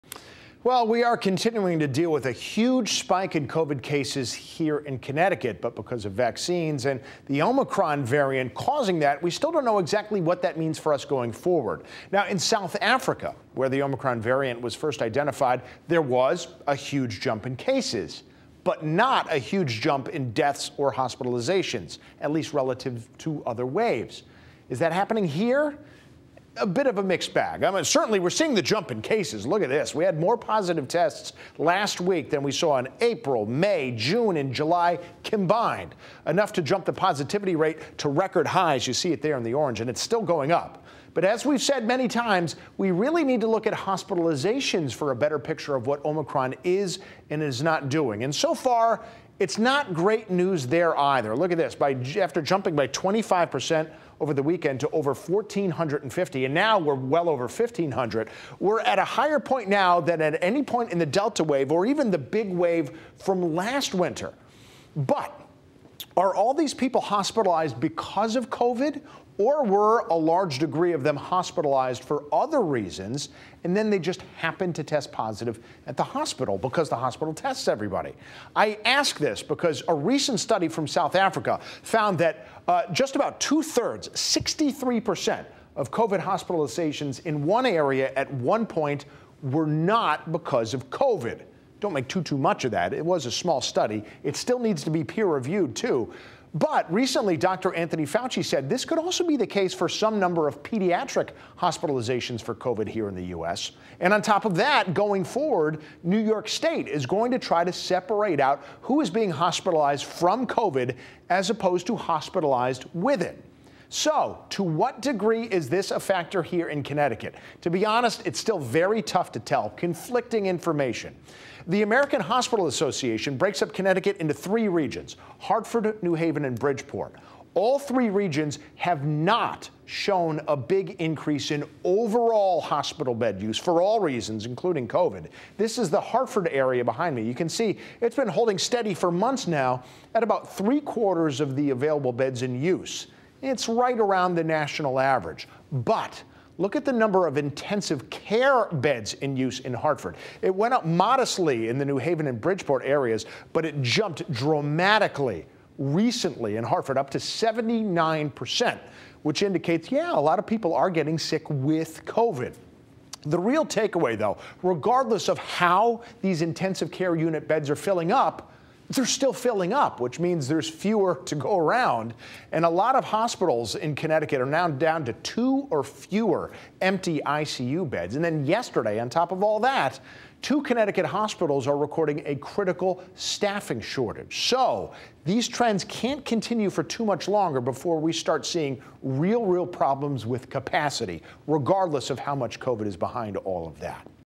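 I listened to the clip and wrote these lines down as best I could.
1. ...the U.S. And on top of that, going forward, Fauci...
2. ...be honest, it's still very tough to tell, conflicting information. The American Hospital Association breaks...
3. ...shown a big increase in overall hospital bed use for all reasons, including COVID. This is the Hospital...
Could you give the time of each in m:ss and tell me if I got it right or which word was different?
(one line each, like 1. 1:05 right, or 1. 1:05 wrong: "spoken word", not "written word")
1. 1:43 wrong: "New", not "Fauci"
2. 1:57 right
3. 2:09 wrong: "Hartford", not "Hospital".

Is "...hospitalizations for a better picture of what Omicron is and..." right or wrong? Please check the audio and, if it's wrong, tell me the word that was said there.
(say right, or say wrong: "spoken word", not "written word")
right.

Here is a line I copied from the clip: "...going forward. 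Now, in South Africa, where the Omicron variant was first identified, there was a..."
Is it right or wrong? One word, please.
right.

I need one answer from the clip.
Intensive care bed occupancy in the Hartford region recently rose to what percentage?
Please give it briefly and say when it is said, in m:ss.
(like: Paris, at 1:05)
79%, at 2:37.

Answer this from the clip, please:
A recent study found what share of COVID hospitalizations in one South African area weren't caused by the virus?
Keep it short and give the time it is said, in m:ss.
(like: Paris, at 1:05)
63%, at 1:24.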